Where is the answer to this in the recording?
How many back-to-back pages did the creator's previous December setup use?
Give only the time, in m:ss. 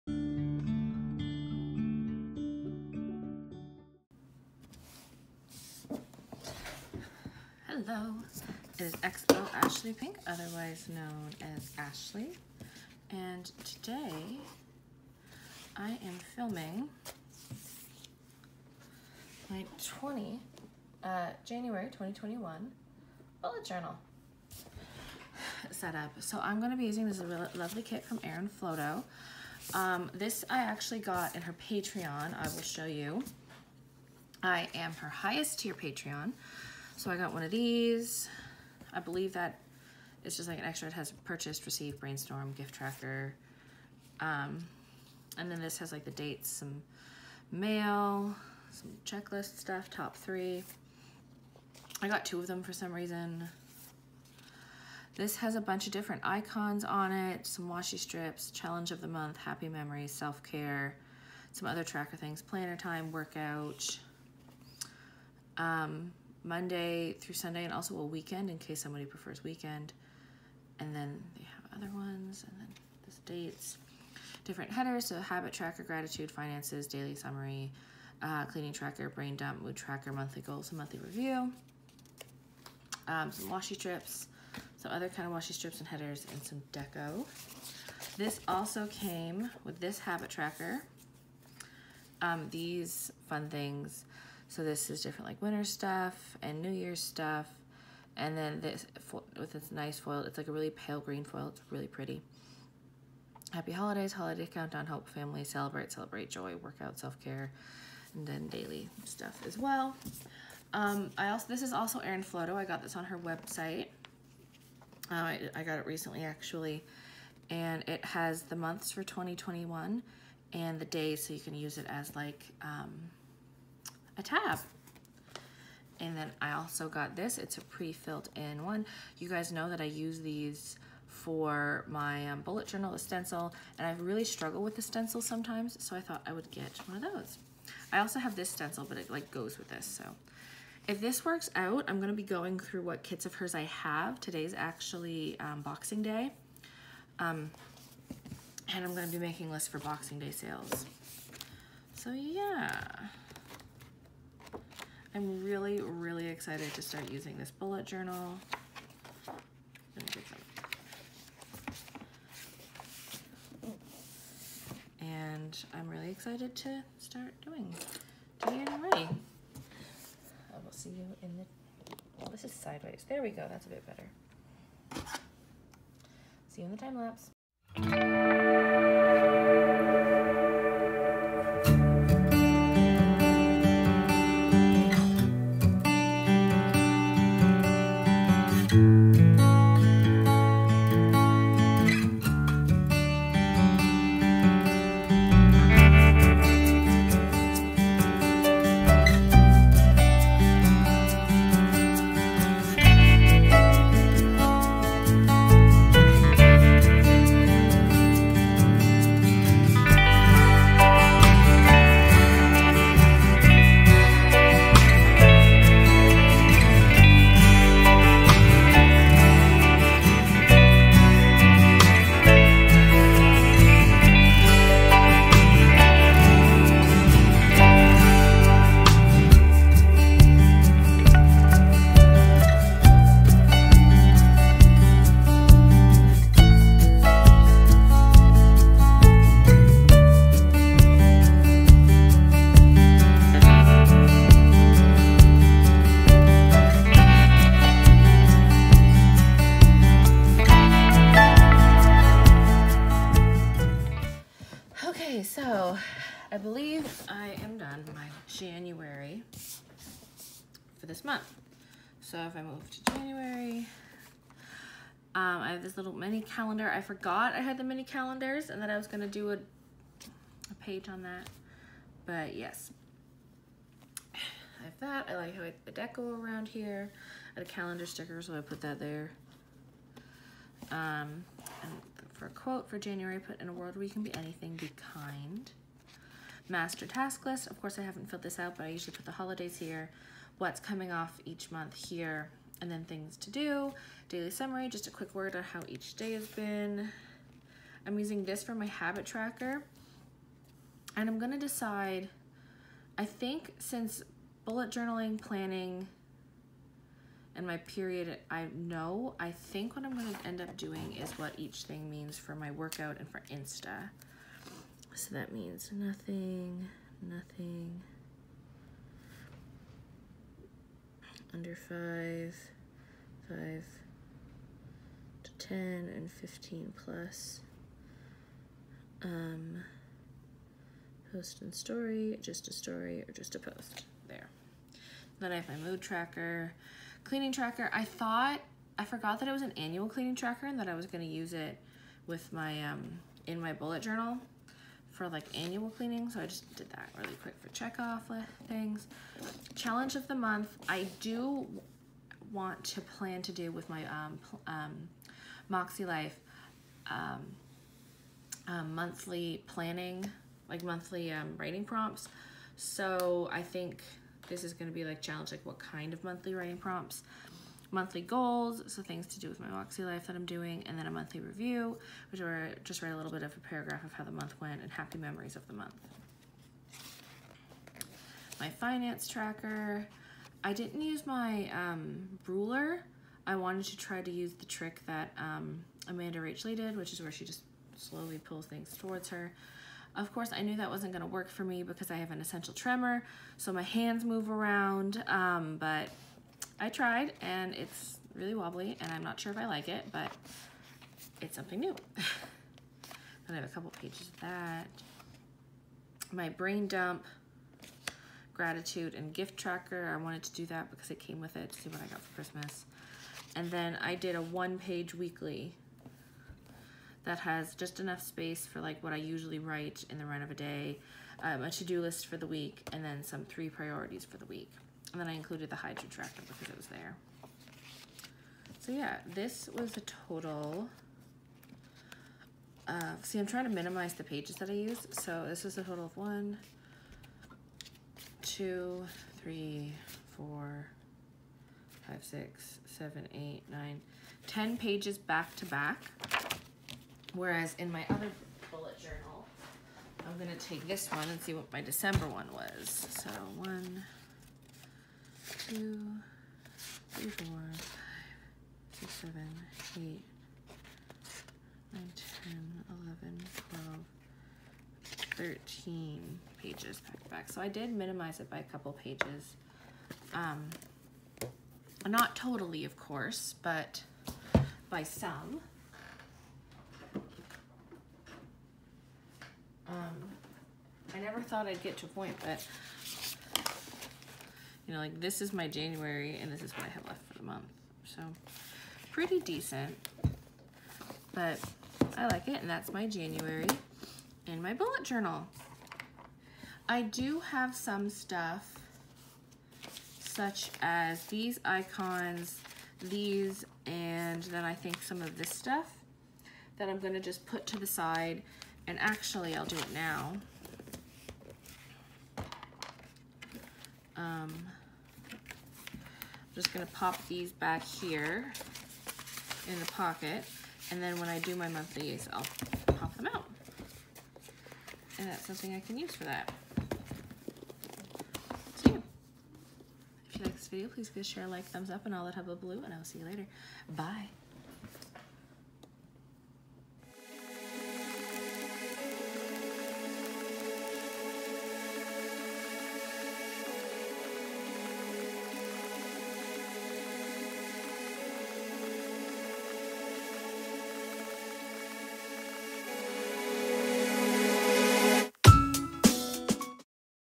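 7:45.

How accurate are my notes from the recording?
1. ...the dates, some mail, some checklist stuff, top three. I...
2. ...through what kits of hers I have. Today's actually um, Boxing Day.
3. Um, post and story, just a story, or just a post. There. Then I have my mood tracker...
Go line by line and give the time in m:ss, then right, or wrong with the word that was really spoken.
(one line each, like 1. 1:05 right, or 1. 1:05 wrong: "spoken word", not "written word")
1. 0:46 right
2. 2:22 right
3. 5:29 right.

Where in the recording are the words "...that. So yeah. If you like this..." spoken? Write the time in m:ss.
8:46.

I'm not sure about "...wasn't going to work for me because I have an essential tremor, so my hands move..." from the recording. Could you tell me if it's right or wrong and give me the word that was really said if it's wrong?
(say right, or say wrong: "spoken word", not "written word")
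right.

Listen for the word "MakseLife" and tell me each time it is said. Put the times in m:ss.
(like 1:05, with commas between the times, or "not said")
5:55, 6:09.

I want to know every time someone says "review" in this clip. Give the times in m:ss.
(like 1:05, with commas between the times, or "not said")
1:20, 6:11.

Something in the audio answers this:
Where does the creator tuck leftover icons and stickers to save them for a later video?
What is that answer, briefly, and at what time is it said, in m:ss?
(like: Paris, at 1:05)
in the pocket, at 8:39.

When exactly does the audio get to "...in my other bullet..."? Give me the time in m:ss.
7:27.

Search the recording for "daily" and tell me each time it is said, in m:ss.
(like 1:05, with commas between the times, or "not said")
1:16, 1:48, 4:54.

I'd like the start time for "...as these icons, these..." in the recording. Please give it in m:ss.
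8:20.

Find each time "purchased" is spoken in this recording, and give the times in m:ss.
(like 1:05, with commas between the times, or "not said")
0:41.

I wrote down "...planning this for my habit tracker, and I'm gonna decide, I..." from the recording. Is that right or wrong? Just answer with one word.
wrong.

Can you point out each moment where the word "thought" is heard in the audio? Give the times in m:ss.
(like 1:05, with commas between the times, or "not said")
2:15, 5:37, 8:01.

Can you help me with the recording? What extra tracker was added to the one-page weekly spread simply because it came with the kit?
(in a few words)
Hydra Tracker.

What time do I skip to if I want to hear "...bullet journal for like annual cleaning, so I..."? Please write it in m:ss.
5:43.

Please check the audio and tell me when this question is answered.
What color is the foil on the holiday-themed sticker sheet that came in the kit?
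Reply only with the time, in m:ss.
1:40.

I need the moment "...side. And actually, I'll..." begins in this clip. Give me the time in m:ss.
8:27.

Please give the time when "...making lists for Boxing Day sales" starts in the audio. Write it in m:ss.
2:29.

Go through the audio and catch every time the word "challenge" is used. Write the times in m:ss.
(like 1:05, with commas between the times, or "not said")
0:58, 5:49, 6:05.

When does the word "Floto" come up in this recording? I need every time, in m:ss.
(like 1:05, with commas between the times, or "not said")
0:28, 1:52.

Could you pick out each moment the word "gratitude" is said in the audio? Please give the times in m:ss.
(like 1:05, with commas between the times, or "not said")
1:15, 6:48.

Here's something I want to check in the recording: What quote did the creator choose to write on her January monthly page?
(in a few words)
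be kind.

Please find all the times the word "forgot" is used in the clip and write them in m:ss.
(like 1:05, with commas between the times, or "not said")
4:26, 5:38.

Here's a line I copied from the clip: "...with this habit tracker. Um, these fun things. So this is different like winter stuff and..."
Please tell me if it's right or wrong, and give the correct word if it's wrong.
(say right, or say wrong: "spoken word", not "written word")
right.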